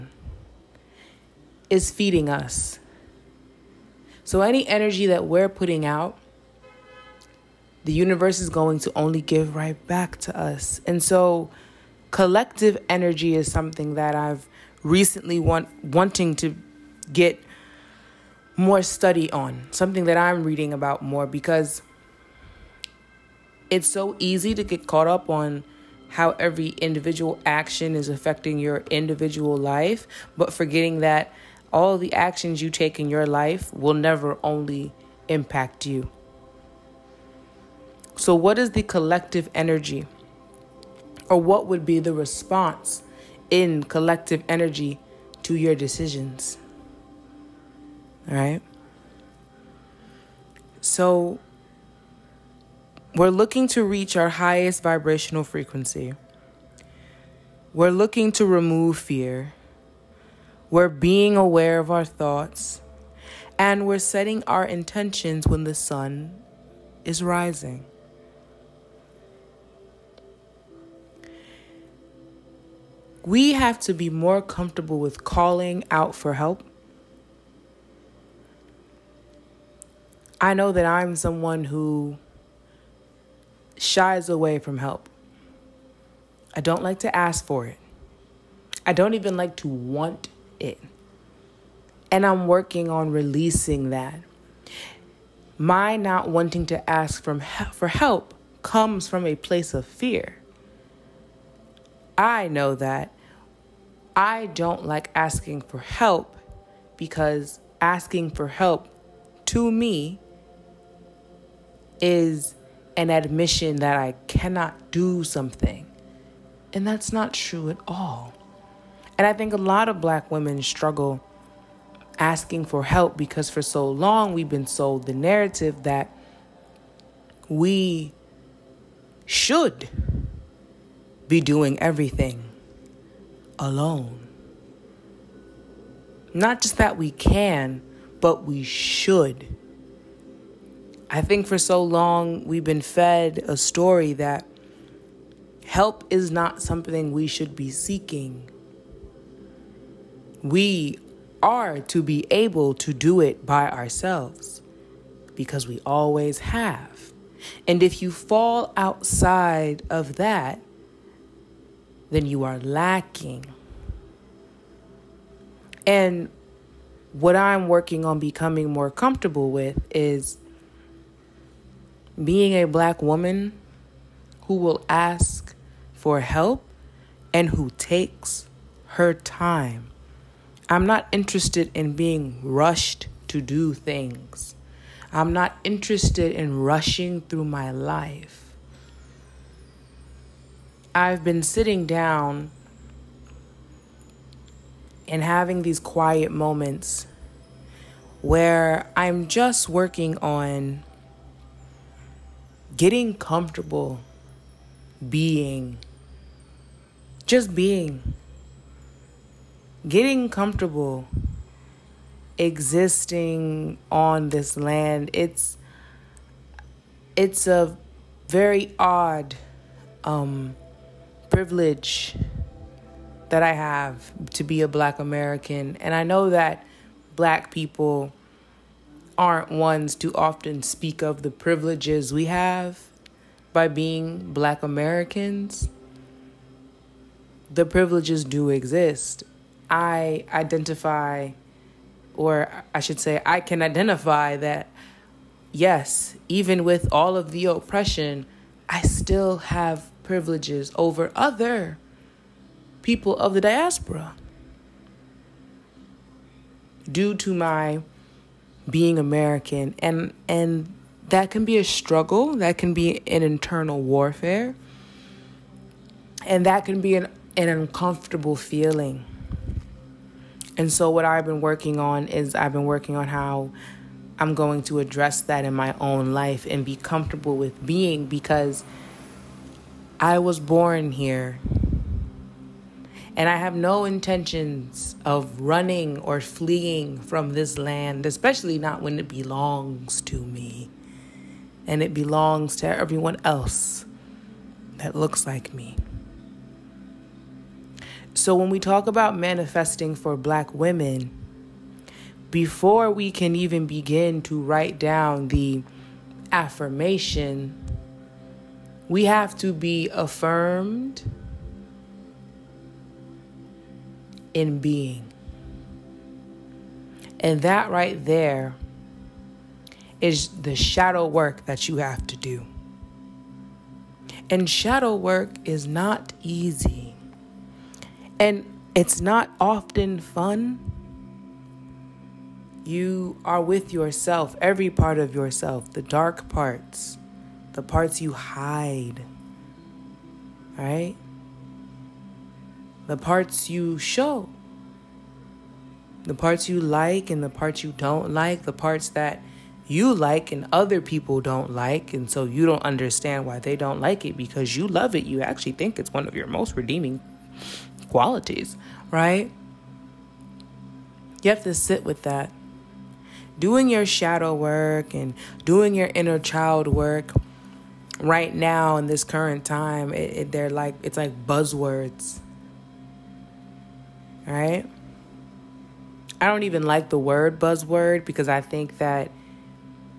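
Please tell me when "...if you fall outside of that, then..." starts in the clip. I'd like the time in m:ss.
2:37.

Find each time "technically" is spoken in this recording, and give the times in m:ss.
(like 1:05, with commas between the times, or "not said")
not said.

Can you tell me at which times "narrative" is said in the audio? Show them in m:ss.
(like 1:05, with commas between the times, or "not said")
2:05.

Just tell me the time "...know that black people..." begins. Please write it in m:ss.
3:46.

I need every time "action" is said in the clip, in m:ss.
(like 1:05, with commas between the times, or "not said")
0:27, 0:32.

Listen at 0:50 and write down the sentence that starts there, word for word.
So, we're looking to reach our highest vibrational frequency.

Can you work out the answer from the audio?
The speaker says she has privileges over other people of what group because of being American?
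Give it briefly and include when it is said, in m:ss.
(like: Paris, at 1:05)
The diaspora, at 4:13.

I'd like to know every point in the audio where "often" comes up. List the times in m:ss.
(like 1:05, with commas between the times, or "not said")
3:50, 5:29.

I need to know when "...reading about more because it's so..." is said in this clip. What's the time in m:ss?
0:20.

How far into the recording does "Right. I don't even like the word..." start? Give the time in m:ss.
6:14.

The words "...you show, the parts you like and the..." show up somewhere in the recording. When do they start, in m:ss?
5:43.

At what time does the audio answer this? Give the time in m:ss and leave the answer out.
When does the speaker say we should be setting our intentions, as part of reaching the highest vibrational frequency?
1:05.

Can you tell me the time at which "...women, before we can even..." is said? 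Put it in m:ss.
5:00.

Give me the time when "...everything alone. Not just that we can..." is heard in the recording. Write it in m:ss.
2:11.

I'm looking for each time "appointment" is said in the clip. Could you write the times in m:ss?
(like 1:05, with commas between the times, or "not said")
not said.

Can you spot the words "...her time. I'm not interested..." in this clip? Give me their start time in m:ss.
2:58.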